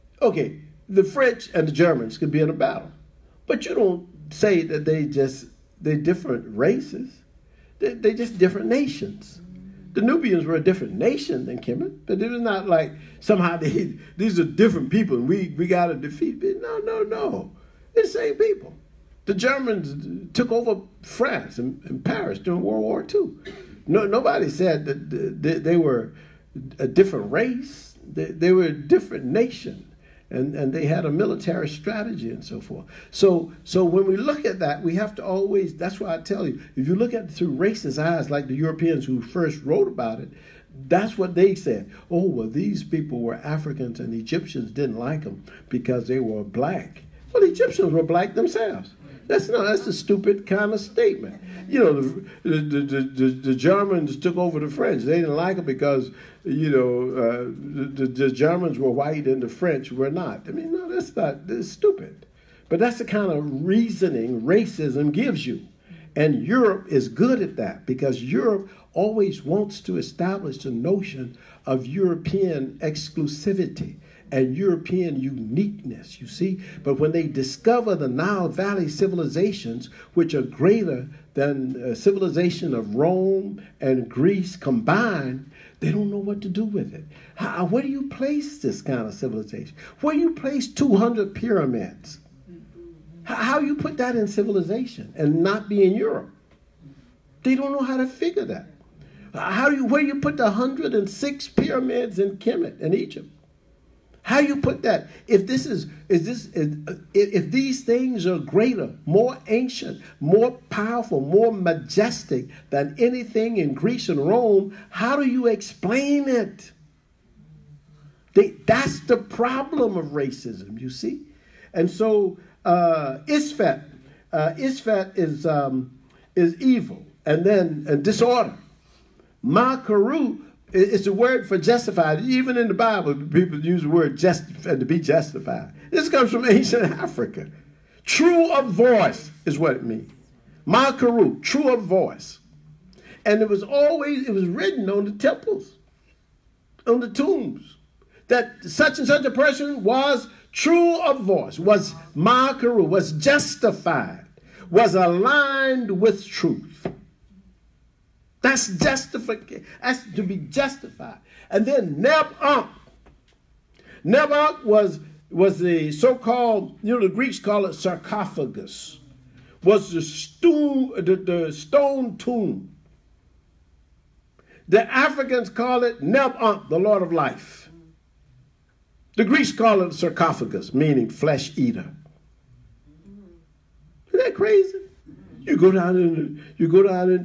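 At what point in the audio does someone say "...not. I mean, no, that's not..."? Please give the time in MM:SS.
01:00.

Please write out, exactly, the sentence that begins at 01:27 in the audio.
How, where do you place this kind of civilization?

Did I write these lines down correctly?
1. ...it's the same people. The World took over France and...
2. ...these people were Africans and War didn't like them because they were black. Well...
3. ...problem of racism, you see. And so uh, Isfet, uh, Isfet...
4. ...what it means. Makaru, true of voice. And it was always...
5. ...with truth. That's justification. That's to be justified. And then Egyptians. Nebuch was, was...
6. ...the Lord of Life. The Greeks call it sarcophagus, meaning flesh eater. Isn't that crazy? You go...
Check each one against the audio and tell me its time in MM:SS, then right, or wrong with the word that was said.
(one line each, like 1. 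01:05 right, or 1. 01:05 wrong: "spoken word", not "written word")
1. 00:17 wrong: "Germans", not "World"
2. 00:42 wrong: "Egyptians", not "War"
3. 01:59 right
4. 02:19 right
5. 02:36 wrong: "Nebuch", not "Egyptians"
6. 02:56 right.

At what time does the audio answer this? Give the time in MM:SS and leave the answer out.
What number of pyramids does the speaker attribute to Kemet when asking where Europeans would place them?
01:40.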